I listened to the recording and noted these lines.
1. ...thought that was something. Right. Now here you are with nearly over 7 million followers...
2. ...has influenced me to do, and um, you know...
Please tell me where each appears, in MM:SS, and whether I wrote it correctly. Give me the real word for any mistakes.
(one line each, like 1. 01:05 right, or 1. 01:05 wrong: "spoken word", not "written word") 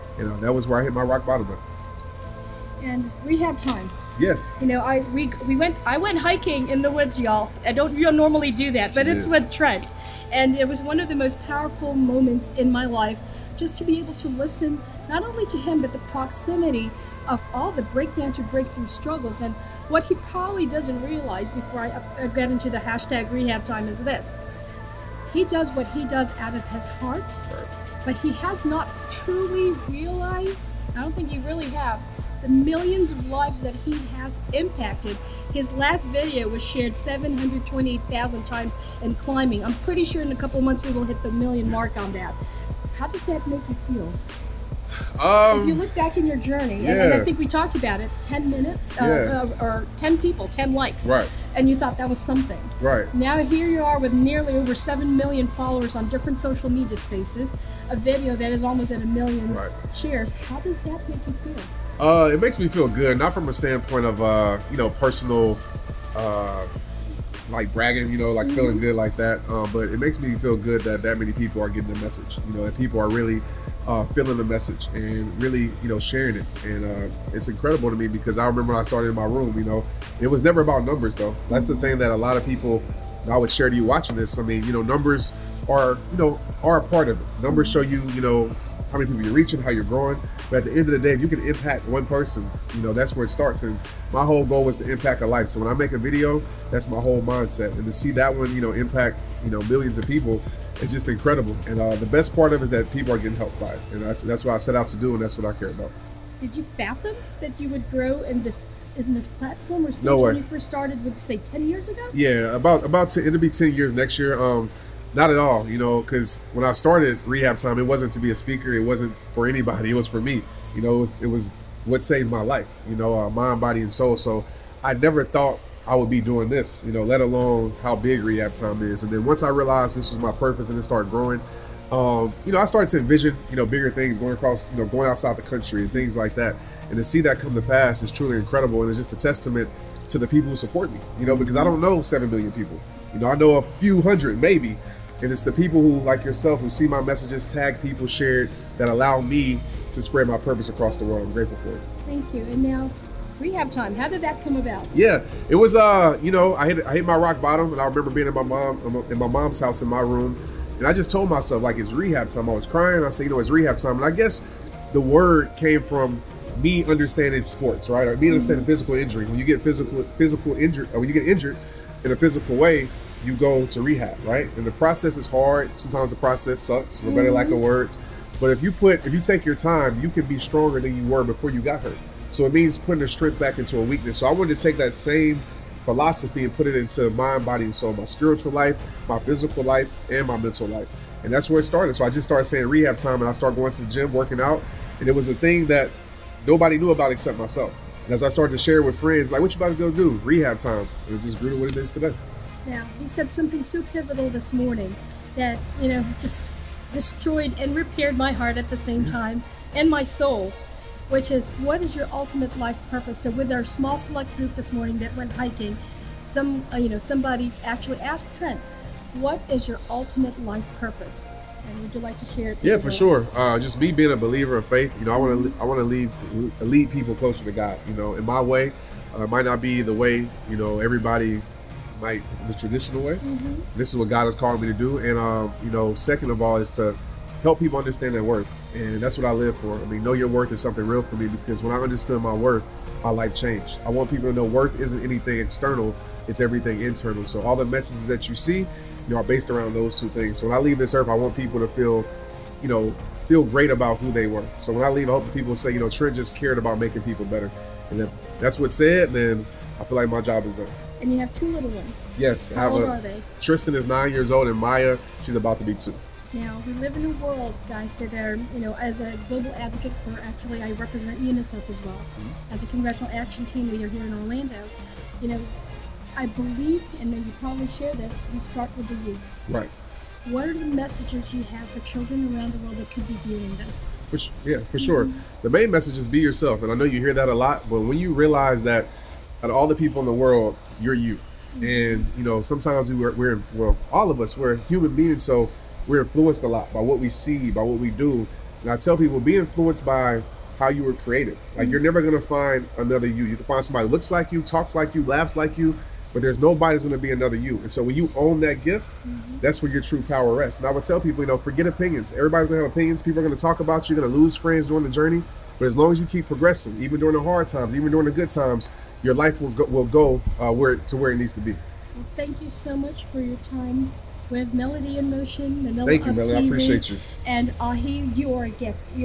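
1. 00:51 right
2. 03:54 wrong: "called", not "influenced".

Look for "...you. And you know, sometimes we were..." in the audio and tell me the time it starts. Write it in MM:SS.
04:50.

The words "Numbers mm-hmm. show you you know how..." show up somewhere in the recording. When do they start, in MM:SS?
01:27.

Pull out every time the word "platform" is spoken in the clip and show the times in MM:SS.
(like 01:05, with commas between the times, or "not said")
01:49.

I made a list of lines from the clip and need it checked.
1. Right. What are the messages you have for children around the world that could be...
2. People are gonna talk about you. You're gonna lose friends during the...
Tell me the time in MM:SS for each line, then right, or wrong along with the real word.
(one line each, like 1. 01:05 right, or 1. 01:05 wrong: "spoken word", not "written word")
1. 04:39 right
2. 05:13 right.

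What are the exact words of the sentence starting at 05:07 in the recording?
And so when you own that gift, mm-hmm.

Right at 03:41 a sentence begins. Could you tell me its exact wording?
And would you like to share it?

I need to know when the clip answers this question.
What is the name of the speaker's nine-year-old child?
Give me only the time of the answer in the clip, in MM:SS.
04:23.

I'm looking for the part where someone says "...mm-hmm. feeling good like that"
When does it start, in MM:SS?
01:08.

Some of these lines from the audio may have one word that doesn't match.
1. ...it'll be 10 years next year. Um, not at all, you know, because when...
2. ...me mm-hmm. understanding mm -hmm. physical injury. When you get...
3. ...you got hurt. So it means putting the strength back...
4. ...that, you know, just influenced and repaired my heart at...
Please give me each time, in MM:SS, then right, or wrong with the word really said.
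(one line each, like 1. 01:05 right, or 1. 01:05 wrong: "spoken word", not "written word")
1. 01:53 right
2. 02:48 right
3. 03:01 right
4. 03:25 wrong: "destroyed", not "influenced".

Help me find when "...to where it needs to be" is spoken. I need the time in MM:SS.
05:20.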